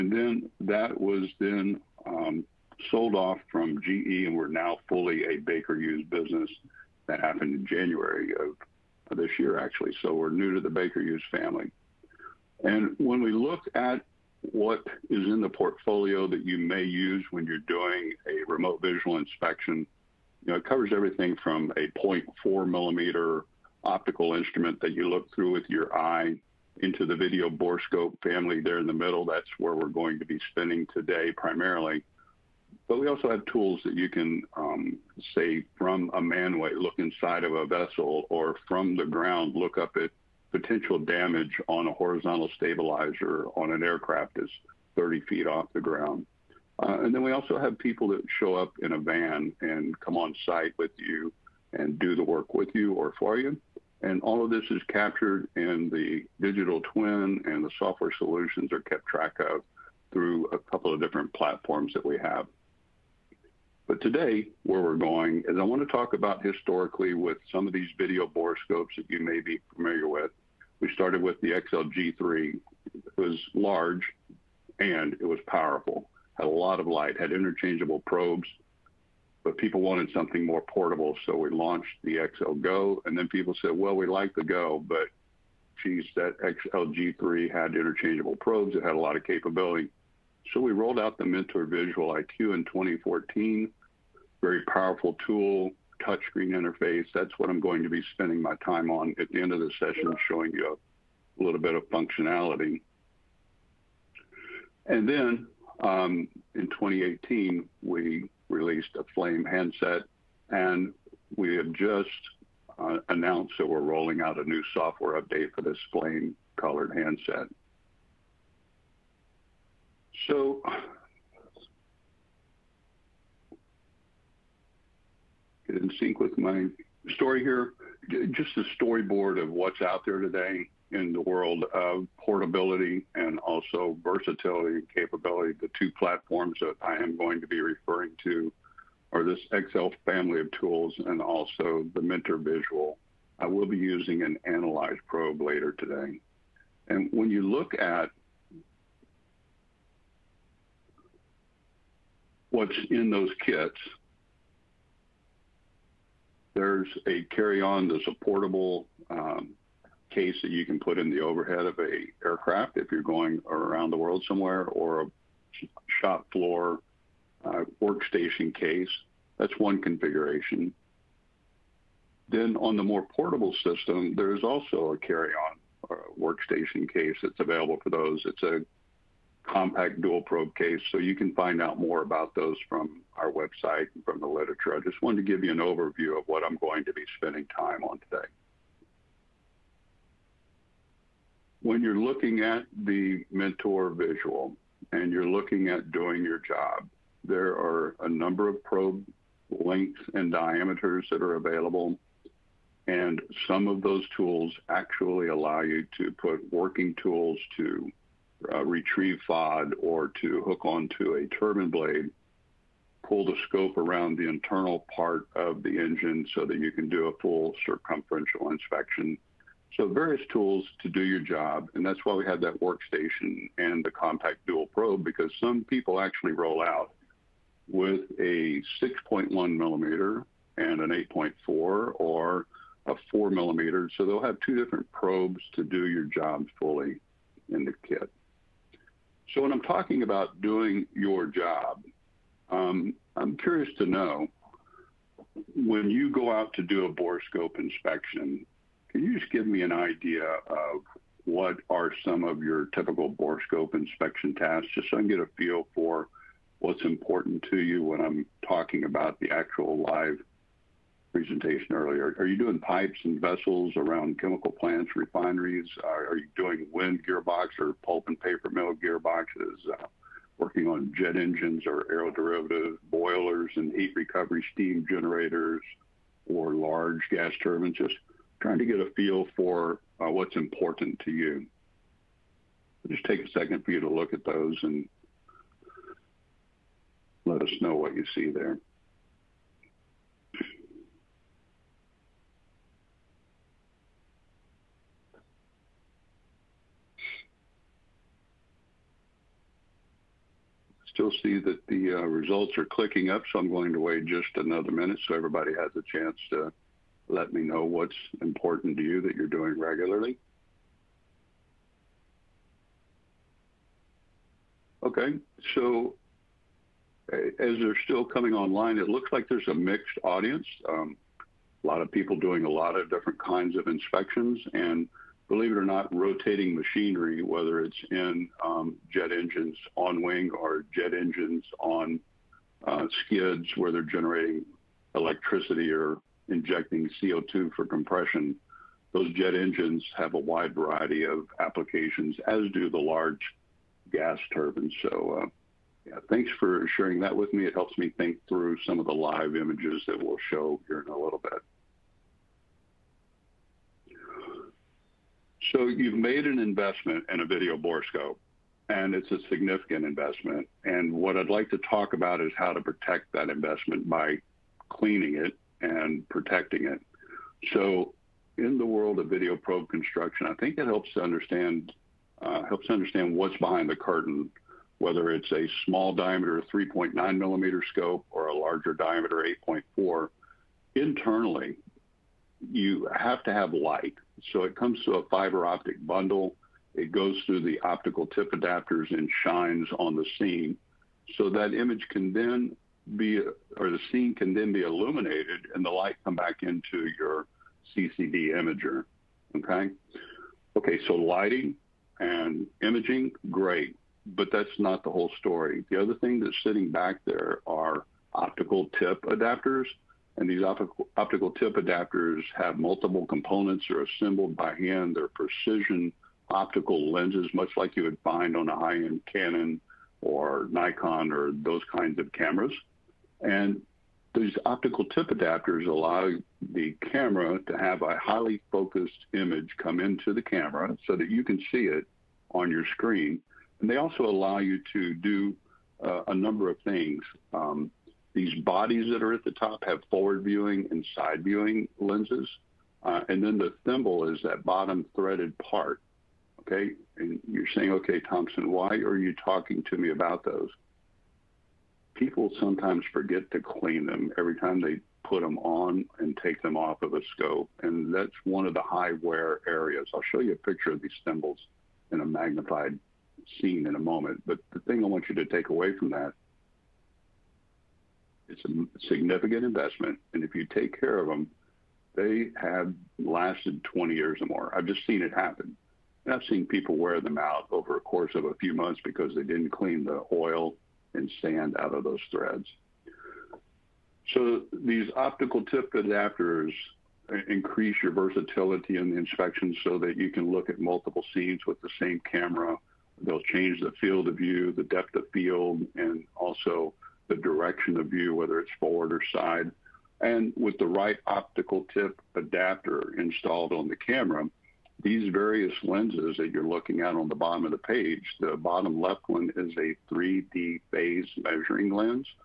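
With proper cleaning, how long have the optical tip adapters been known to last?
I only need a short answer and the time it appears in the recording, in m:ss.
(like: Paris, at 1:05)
20 years or more, at 7:53.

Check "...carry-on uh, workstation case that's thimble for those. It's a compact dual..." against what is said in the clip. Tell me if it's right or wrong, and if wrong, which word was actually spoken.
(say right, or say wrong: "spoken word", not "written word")
wrong: "available", not "thimble".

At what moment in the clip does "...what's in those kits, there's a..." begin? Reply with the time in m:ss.
2:32.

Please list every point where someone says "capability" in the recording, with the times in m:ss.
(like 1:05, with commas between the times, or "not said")
1:29, 2:14.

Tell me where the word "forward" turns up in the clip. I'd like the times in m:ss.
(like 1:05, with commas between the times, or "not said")
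7:19, 8:18.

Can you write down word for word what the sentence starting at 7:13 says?
And they also allow you to do uh, a number of things.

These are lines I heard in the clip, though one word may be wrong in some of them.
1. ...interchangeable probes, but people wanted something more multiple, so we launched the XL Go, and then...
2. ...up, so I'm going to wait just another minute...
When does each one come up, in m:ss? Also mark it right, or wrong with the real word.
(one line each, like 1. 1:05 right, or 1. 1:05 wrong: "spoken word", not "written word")
1. 1:17 wrong: "portable", not "multiple"
2. 5:03 right.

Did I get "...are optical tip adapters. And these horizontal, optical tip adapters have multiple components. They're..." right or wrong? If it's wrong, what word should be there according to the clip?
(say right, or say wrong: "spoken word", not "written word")
wrong: "optical", not "horizontal".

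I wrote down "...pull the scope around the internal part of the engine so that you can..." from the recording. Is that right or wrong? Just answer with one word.
right.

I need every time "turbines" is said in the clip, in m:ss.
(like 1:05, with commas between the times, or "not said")
3:31, 4:37, 5:44.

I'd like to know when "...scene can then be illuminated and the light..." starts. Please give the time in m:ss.
6:33.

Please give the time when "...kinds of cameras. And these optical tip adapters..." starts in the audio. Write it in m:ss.
7:01.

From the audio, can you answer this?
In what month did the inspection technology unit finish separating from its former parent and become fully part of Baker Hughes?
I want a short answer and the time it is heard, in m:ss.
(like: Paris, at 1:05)
January, at 0:07.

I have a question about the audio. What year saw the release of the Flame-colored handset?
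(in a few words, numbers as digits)
2018.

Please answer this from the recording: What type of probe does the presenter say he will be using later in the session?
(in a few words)
Analyze probe.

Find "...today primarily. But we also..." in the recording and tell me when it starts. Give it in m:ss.
0:30.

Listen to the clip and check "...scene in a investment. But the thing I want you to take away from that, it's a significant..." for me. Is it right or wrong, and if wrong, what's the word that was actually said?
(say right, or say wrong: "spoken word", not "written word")
wrong: "moment", not "investment".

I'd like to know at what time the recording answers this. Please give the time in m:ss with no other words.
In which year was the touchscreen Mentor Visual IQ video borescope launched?
1:32.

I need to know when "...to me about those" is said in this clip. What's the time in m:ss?
7:29.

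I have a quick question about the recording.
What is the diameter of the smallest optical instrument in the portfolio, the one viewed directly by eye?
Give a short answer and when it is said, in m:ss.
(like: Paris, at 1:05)
0.4 millimeter, at 0:22.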